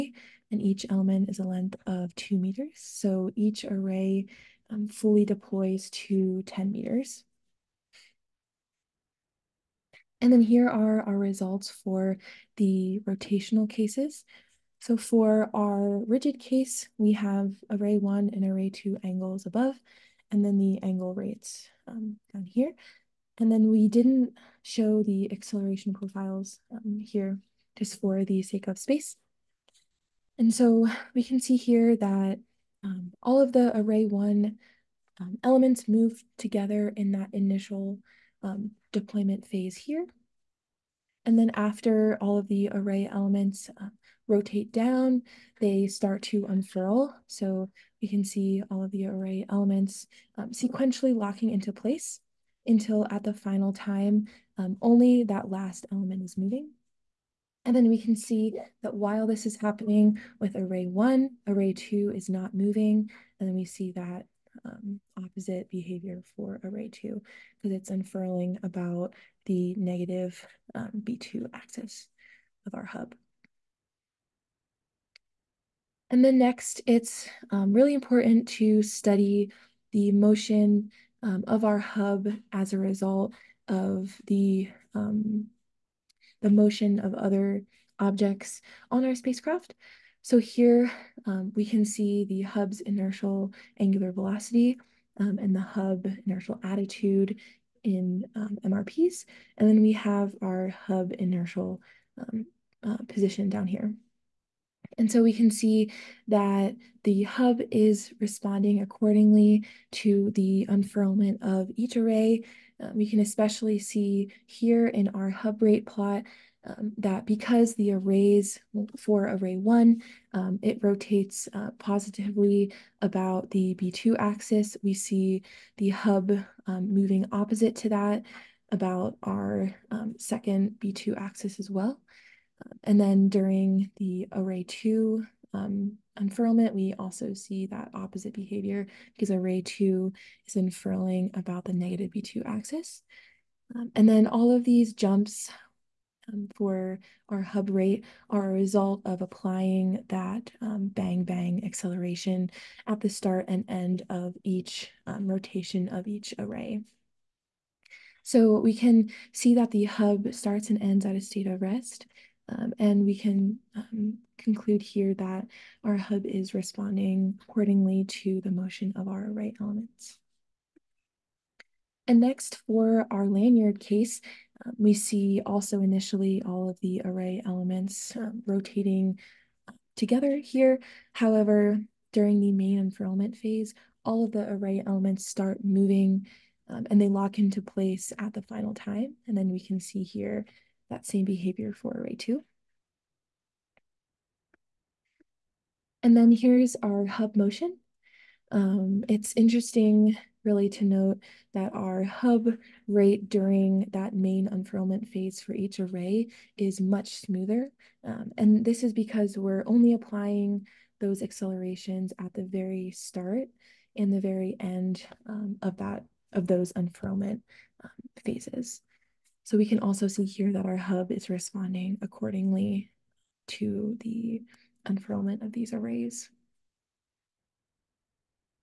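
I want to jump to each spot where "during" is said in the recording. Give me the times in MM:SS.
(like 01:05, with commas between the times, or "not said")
02:13, 03:02, 03:23.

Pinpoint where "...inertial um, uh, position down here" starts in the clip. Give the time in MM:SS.
01:41.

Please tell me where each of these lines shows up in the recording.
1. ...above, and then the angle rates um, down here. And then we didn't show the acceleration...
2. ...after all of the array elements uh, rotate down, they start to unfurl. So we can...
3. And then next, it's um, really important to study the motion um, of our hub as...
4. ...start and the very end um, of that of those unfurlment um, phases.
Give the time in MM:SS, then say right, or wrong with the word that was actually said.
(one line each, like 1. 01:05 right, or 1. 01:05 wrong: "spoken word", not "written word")
1. 00:19 right
2. 00:41 right
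3. 01:16 right
4. 03:32 right.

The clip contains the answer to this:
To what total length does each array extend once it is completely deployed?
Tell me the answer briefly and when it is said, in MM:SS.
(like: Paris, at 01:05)
10 meters, at 00:06.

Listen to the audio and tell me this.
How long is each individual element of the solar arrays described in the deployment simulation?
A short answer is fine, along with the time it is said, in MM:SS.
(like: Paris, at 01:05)
2 meters, at 00:02.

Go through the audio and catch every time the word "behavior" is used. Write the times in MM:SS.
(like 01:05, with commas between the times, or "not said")
01:05, 02:18, 03:11.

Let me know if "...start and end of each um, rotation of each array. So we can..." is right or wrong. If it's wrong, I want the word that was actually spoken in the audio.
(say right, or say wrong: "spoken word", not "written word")
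right.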